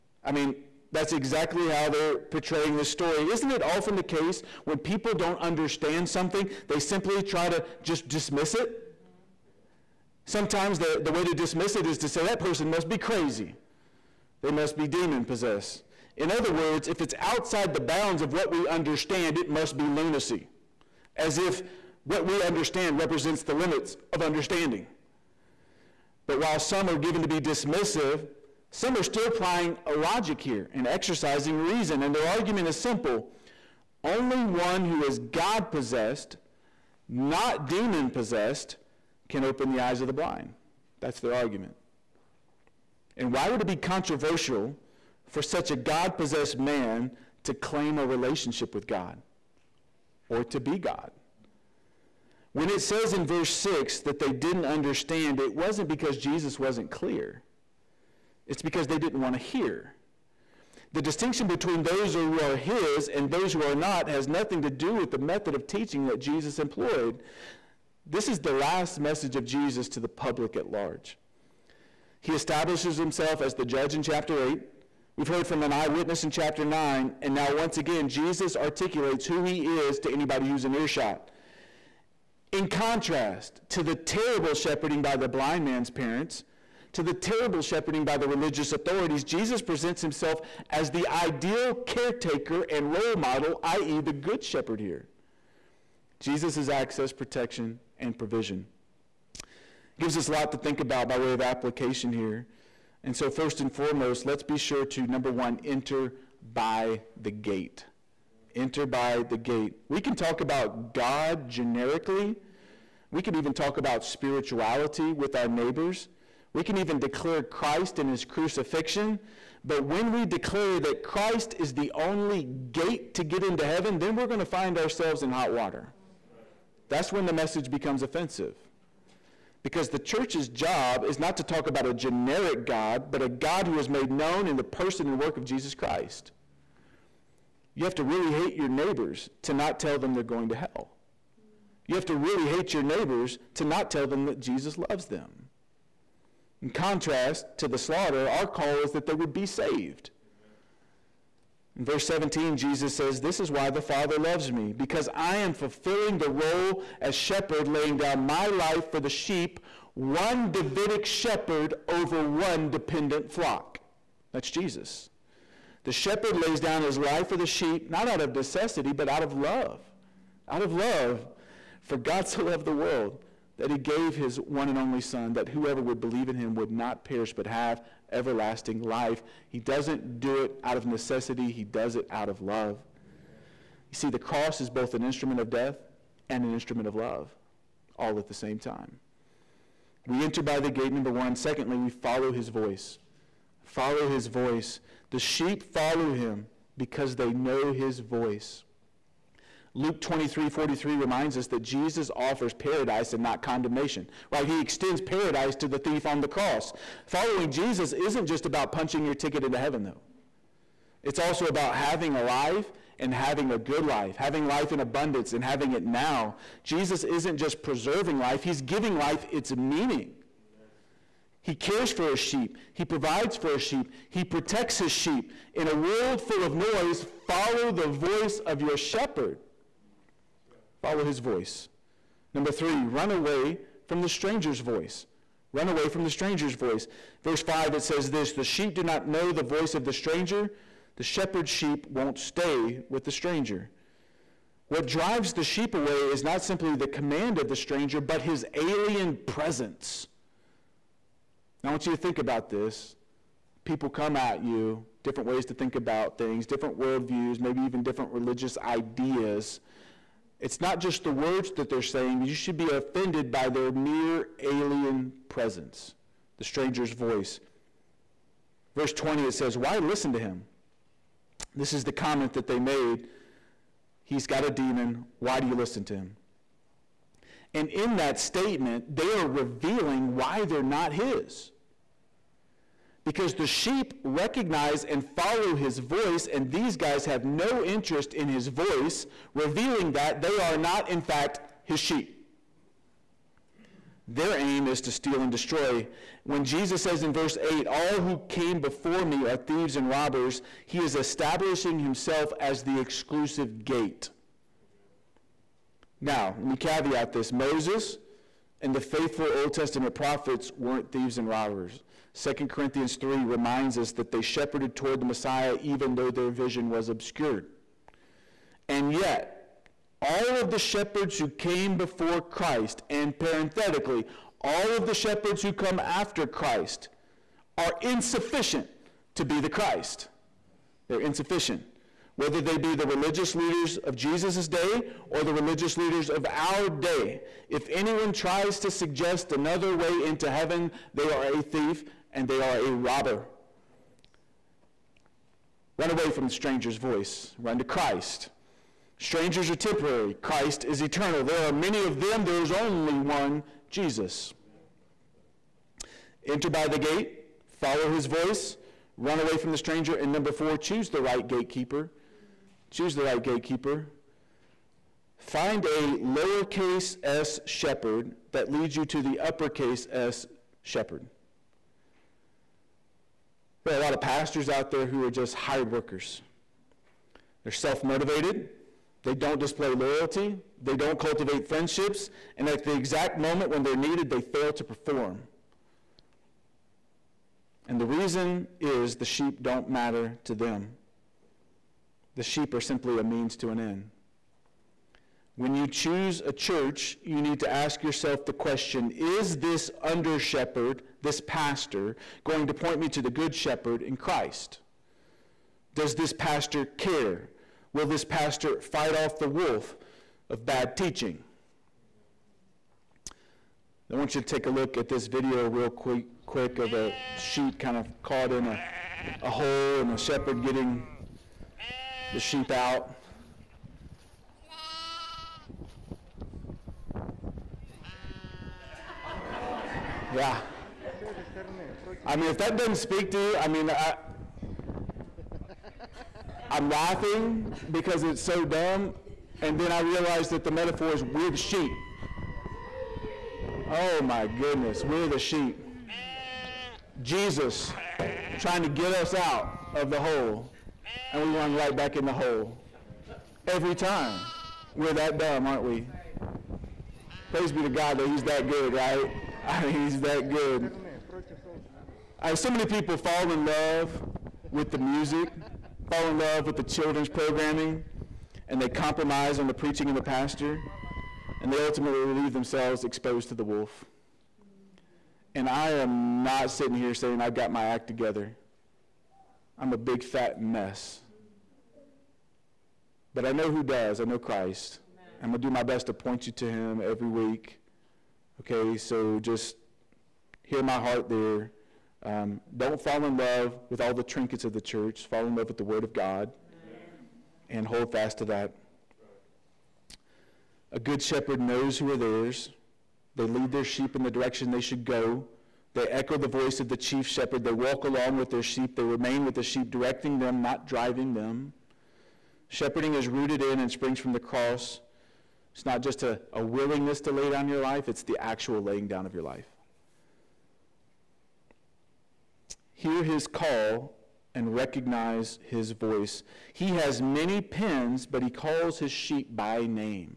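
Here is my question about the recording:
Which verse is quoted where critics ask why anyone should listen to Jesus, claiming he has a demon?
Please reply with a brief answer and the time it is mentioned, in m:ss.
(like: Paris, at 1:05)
Verse 20, at 4:28.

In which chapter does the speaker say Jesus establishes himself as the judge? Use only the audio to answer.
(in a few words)
Chapter 8.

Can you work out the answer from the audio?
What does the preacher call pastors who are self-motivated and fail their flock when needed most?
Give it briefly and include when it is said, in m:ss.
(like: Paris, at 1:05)
Hired workers, at 6:15.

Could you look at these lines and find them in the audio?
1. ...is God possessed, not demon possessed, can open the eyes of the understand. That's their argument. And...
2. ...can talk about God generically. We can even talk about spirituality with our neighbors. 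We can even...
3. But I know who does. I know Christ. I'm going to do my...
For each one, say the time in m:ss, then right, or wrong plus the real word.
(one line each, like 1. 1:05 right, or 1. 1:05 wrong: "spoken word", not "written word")
1. 0:35 wrong: "blind", not "understand"
2. 1:49 right
3. 8:03 right.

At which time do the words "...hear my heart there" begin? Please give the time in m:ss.
8:10.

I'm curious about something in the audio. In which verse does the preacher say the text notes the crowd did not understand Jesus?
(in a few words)
Verse 6.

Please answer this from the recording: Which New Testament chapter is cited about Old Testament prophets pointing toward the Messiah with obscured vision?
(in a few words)
2 Corinthians 3.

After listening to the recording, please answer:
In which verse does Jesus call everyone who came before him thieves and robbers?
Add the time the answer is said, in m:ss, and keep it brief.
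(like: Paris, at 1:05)
Verse 8, at 4:57.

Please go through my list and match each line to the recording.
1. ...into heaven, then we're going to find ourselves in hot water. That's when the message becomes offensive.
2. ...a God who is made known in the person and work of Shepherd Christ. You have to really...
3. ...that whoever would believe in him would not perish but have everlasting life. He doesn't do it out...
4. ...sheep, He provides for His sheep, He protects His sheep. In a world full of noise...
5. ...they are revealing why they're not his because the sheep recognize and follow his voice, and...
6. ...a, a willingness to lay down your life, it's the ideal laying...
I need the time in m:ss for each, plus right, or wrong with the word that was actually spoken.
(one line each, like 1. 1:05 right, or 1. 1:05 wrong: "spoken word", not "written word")
1. 2:03 right
2. 2:13 wrong: "Jesus", not "Shepherd"
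3. 2:55 right
4. 3:42 right
5. 4:38 right
6. 8:36 wrong: "actual", not "ideal".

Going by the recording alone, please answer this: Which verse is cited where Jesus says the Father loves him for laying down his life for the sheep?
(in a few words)
Verse 17.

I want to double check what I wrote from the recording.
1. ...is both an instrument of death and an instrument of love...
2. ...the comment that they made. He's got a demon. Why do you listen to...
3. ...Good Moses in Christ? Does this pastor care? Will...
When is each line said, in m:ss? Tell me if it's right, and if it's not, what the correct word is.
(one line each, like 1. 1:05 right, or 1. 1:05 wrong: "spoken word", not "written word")
1. 3:04 right
2. 4:31 right
3. 6:43 wrong: "Shepherd", not "Moses".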